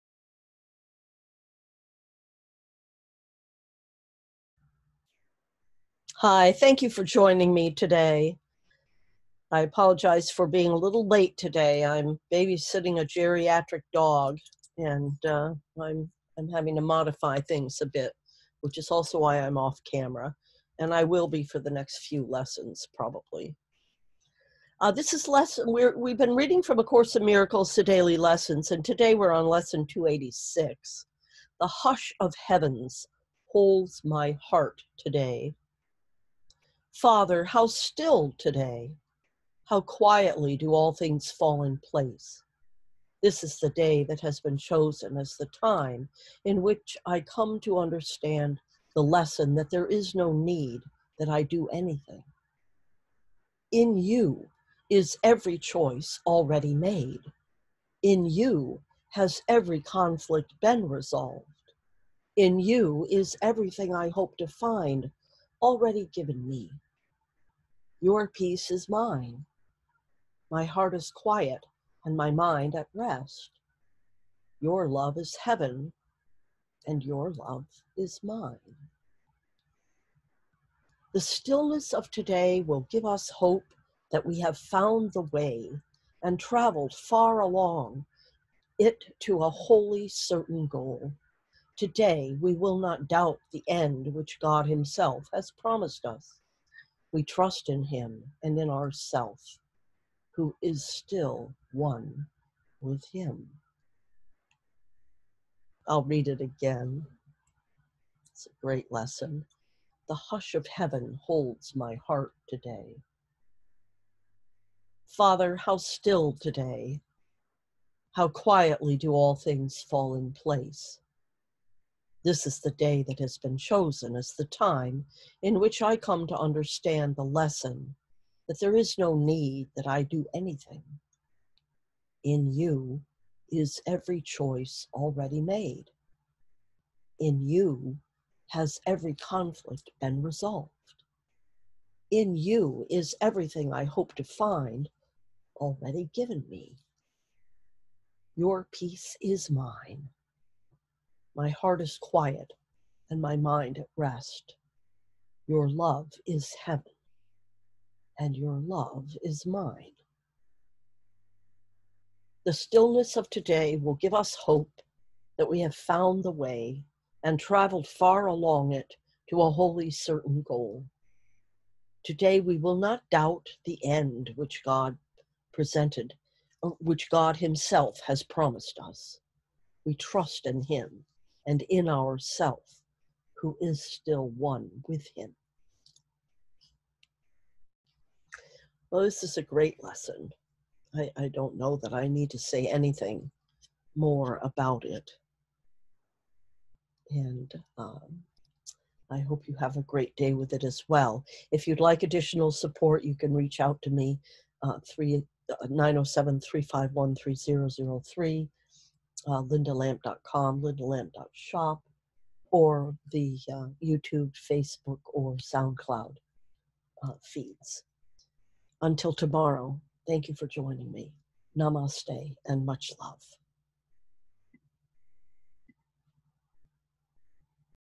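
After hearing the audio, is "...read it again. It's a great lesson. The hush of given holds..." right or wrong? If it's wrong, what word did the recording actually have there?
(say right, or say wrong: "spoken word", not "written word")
wrong: "heaven", not "given".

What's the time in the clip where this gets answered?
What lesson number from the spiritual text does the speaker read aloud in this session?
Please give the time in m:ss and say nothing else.
0:29.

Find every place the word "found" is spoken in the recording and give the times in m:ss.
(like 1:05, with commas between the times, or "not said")
1:24, 2:45.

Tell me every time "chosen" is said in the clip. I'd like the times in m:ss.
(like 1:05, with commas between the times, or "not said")
0:44, 2:03.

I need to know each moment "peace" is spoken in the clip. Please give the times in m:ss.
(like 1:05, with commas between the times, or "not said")
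1:08, 2:28.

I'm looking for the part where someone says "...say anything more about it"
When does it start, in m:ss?
3:12.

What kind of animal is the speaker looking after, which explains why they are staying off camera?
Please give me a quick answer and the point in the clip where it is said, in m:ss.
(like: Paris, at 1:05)
Dog, at 0:13.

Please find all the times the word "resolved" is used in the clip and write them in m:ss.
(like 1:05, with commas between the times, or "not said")
1:00, 2:20.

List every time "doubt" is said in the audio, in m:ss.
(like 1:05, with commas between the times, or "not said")
1:33, 2:53.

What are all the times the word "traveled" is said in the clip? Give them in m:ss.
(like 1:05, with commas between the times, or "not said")
1:26, 2:47.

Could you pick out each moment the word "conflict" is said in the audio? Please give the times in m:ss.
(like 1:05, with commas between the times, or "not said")
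0:59, 2:19.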